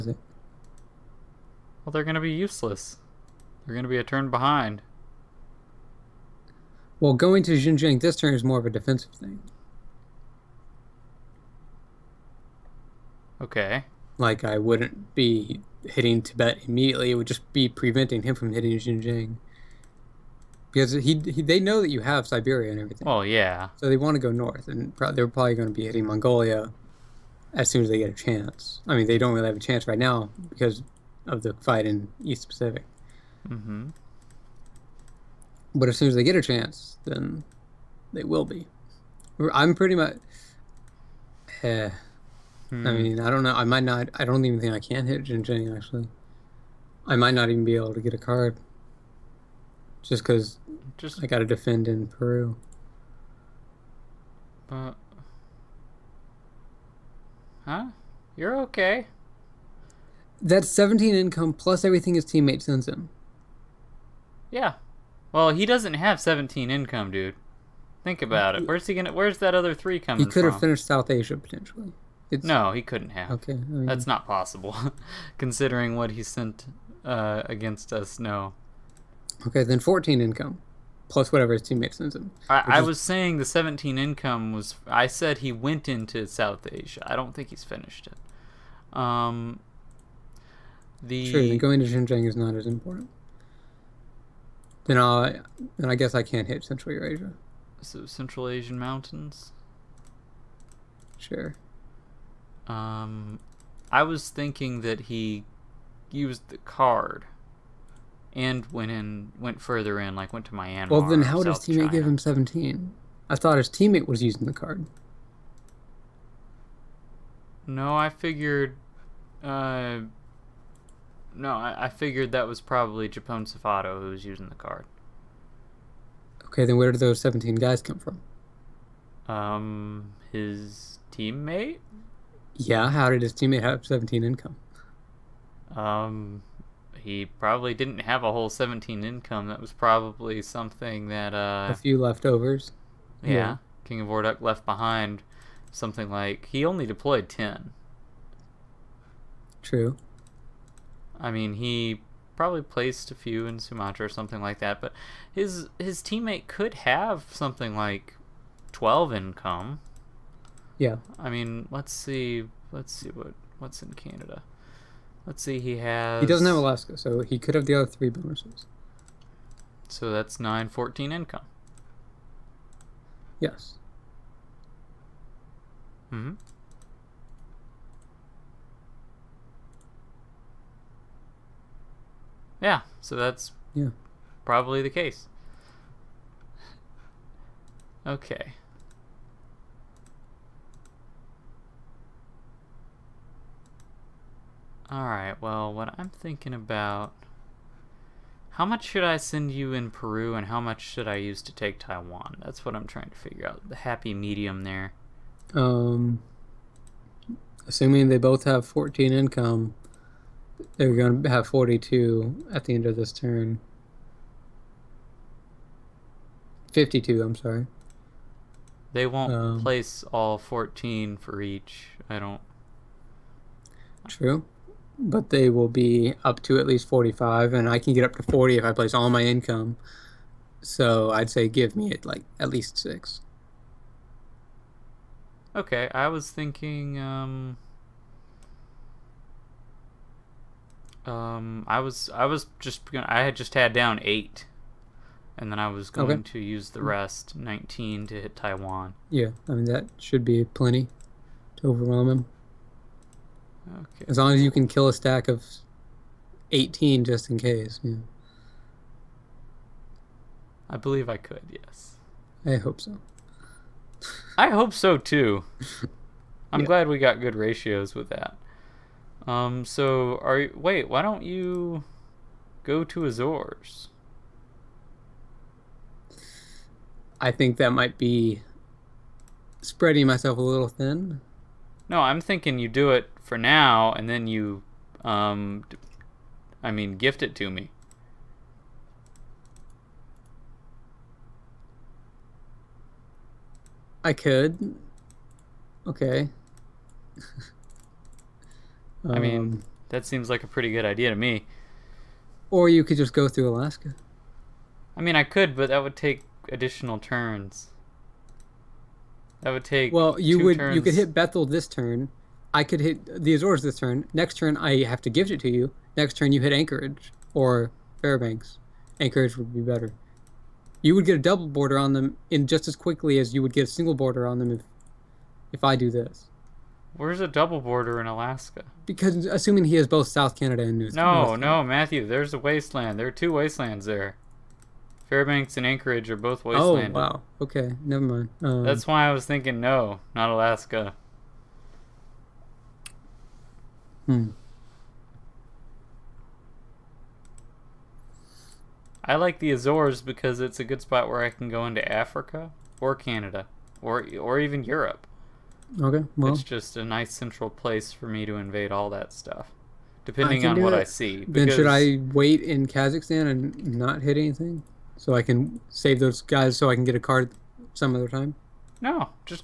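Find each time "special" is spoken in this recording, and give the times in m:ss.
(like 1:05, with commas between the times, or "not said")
not said.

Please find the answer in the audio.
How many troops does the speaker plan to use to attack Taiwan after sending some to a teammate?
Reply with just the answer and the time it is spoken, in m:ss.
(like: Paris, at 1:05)
19, at 4:07.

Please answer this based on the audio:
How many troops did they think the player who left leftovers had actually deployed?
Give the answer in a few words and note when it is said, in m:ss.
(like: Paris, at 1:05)
10, at 2:27.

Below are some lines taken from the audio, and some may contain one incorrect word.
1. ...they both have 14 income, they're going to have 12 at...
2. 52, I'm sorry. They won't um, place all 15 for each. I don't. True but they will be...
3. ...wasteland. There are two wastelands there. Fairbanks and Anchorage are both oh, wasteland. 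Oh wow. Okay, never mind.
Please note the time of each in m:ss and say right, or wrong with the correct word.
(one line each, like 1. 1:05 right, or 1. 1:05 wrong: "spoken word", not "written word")
1. 3:28 wrong: "42", not "12"
2. 3:36 wrong: "14", not "15"
3. 5:32 right.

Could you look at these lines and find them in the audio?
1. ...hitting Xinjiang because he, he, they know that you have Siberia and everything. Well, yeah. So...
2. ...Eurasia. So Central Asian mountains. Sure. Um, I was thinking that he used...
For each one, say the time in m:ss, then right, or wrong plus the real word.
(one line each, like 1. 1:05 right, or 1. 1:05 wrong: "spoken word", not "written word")
1. 0:18 right
2. 1:36 right.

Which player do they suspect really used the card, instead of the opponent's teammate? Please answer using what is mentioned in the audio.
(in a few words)
JaponeSafado.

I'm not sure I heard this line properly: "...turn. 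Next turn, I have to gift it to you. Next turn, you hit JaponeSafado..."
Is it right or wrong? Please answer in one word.
wrong.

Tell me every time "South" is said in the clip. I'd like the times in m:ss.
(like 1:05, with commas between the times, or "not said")
1:10, 1:26, 5:30.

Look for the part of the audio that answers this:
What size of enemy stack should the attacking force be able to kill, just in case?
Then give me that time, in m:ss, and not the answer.
4:16.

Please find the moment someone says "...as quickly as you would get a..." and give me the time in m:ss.
5:22.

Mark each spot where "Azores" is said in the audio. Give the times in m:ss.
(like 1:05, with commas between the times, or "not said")
4:33, 5:13, 5:49.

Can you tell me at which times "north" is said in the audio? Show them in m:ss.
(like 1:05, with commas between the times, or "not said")
0:24, 5:31.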